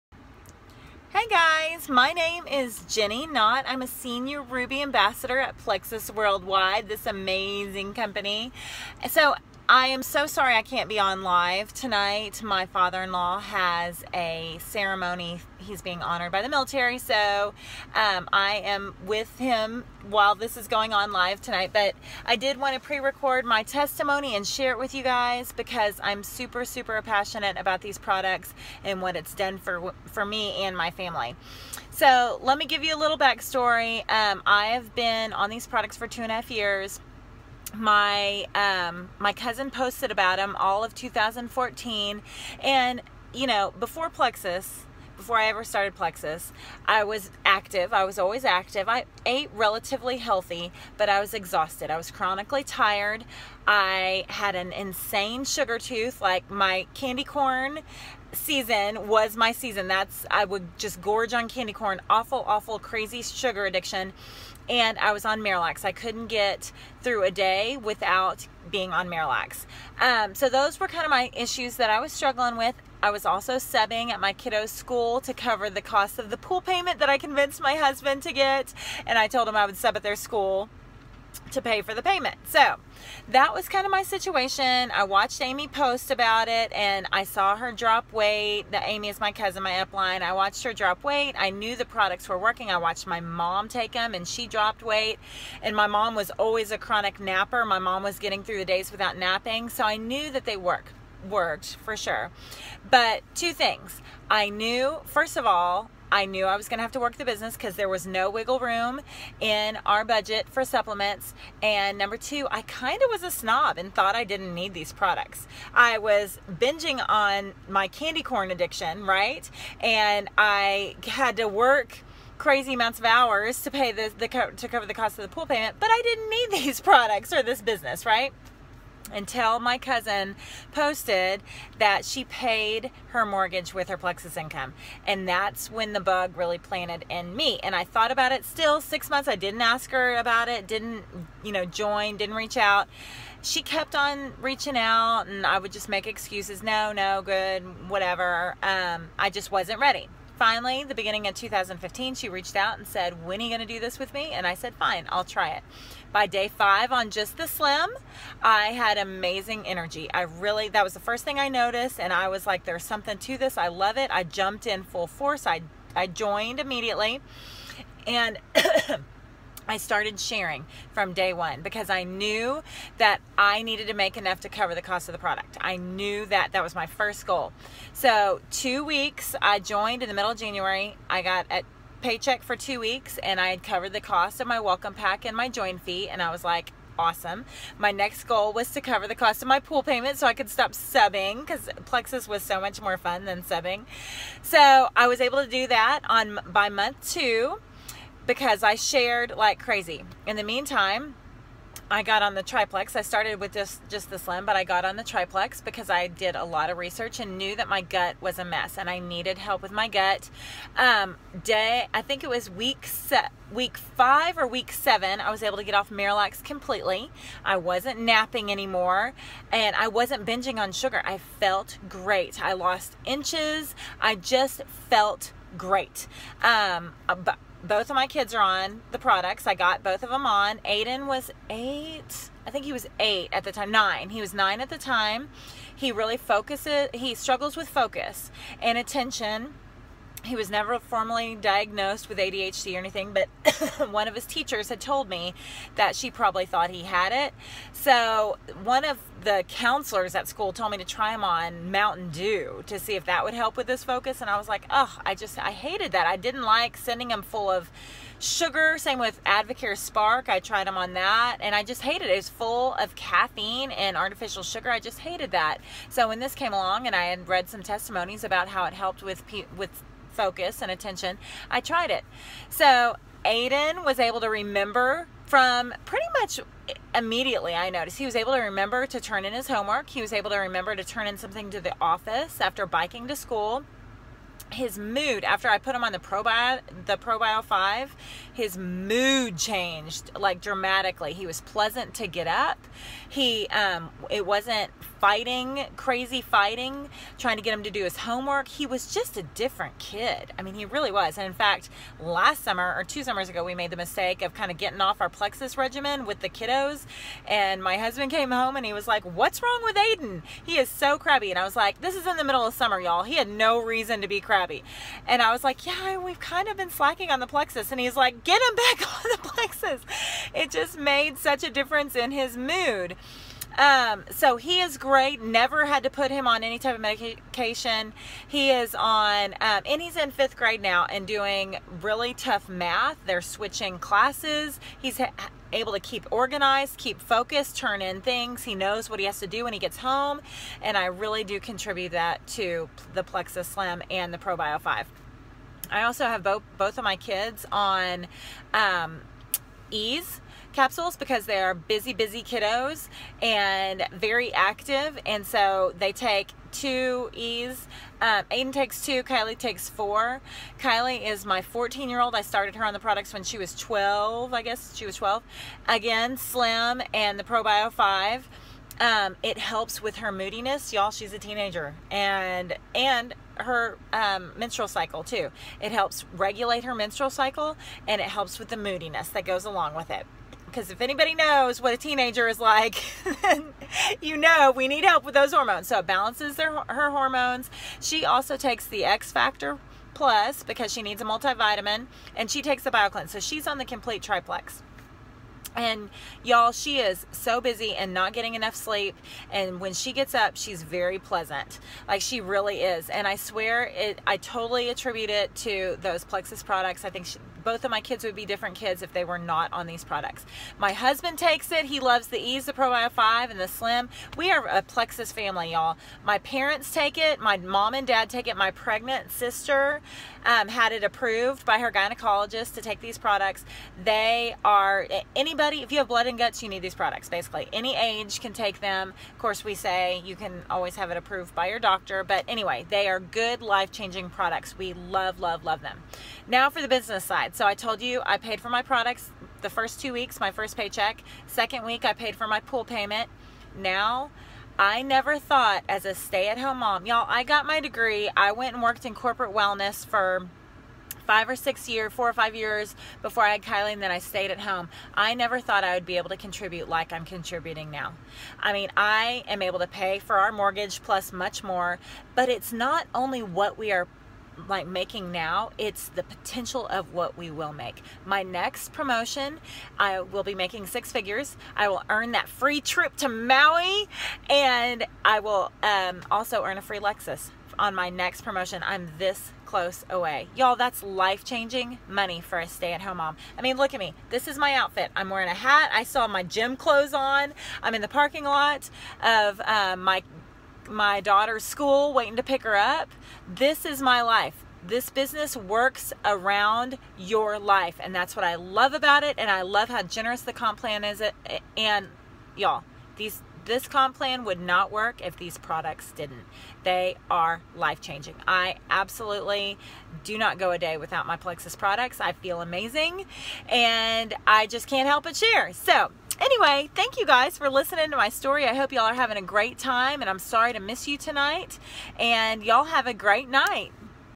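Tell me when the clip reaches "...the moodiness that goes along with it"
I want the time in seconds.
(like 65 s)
378 s.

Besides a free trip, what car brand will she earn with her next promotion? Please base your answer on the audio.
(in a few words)
Lexus.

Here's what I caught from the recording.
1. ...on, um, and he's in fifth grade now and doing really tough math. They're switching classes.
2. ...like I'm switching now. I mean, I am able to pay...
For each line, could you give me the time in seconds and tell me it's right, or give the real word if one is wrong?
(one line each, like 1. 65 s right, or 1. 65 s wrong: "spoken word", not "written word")
1. 328 s right
2. 456 s wrong: "contributing", not "switching".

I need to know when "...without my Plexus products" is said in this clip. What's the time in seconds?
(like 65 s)
510 s.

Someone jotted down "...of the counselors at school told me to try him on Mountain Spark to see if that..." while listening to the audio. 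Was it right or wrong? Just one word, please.
wrong.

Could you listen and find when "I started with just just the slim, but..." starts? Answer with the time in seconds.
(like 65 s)
202 s.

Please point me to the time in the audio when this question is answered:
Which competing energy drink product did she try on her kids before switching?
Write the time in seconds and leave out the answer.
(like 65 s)
259 s.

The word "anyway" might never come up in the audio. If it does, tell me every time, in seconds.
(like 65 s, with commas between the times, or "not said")
432 s, 516 s.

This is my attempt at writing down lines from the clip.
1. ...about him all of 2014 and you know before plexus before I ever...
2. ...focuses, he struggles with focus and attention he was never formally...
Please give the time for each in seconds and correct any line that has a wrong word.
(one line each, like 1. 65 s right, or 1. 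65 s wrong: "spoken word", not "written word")
1. 40 s right
2. 236 s right.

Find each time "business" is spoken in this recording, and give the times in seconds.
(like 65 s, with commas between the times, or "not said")
107 s, 127 s, 436 s, 494 s.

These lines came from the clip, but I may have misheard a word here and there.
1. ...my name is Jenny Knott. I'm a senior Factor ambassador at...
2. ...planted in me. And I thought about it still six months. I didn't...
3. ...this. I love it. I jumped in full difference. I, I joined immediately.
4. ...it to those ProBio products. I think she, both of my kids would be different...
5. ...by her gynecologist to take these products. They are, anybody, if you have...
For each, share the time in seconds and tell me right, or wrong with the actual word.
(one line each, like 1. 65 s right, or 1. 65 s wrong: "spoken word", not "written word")
1. 1 s wrong: "Ruby", not "Factor"
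2. 136 s right
3. 163 s wrong: "force", not "difference"
4. 405 s wrong: "Plexus", not "ProBio"
5. 421 s right.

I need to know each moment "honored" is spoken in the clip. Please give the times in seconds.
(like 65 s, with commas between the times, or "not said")
16 s.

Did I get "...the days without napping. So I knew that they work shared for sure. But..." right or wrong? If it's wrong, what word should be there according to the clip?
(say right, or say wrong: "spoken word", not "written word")
wrong: "worked", not "shared".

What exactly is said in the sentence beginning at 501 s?
And y'all, these this comp plan would not work if these products didn't.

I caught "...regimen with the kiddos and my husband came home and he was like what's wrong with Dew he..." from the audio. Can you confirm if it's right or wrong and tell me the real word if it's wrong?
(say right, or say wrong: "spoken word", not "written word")
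wrong: "Aiden", not "Dew".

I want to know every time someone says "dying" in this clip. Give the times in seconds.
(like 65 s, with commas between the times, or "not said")
not said.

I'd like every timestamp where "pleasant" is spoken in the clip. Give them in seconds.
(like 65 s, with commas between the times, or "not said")
291 s, 400 s.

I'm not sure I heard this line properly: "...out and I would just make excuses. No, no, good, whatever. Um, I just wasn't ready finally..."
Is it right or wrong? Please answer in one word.
right.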